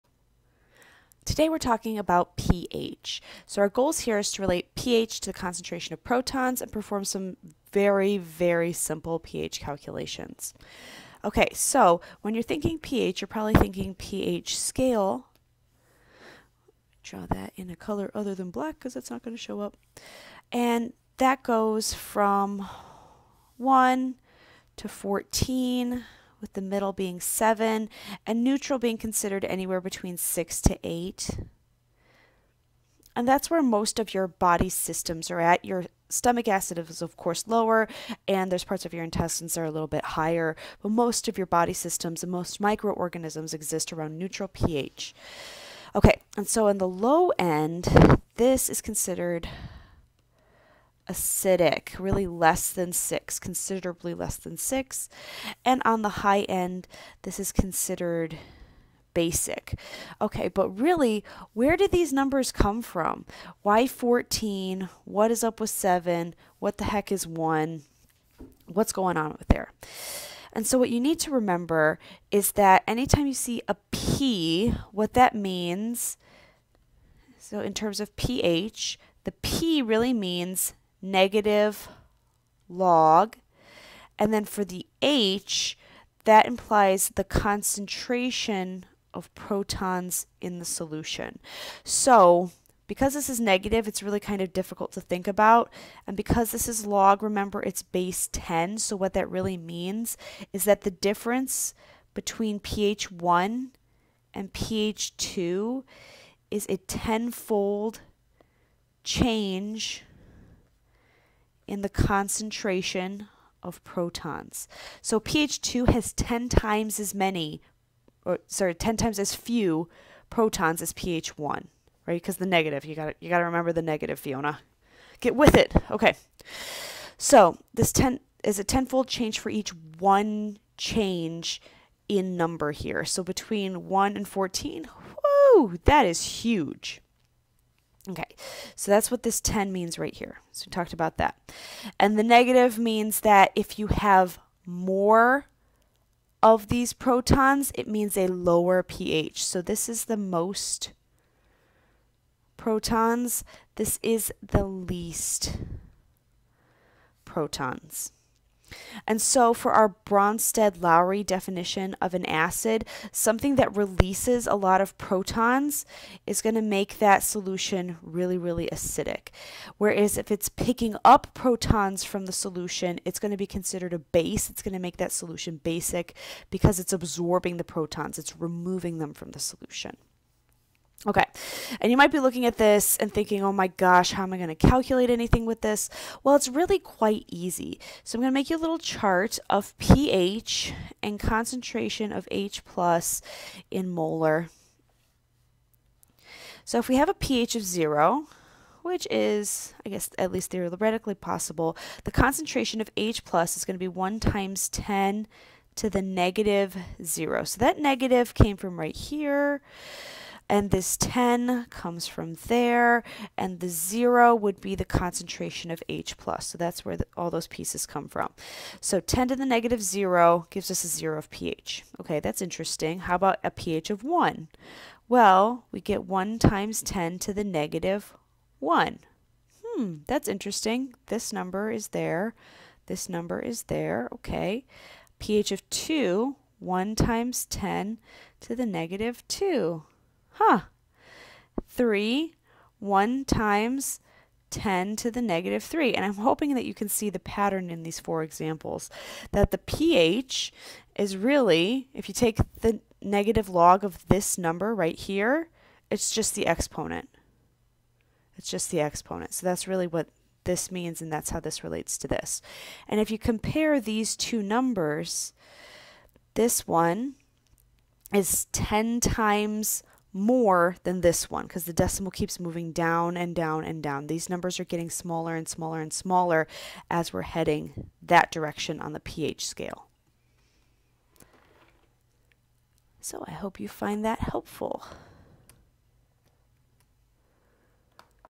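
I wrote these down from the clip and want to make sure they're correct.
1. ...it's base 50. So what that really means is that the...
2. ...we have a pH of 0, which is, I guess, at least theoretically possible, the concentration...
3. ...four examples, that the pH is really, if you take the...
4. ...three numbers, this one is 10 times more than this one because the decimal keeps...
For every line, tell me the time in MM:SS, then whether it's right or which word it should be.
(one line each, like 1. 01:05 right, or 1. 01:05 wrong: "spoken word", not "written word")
1. 01:37 wrong: "10", not "50"
2. 03:16 right
3. 04:07 right
4. 04:24 wrong: "two", not "three".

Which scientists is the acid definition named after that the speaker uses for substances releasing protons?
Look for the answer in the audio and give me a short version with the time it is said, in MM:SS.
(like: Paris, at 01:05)
Bronsted Lowry, at 02:39.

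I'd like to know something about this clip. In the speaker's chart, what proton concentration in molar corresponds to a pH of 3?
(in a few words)
1 x 10^-3.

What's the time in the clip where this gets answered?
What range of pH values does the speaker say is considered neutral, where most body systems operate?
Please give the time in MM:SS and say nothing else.
00:29.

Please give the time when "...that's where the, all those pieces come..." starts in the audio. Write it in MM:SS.
03:36.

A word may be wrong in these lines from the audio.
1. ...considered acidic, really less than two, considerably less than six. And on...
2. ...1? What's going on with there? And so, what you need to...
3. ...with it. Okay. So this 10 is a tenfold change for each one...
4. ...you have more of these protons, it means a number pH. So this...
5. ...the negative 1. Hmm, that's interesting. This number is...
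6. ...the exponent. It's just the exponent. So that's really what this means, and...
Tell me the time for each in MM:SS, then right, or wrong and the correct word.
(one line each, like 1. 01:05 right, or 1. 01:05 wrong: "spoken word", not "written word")
1. 00:48 wrong: "six", not "two"
2. 01:07 right
3. 02:05 right
4. 02:23 wrong: "lower", not "number"
5. 03:47 right
6. 04:16 right.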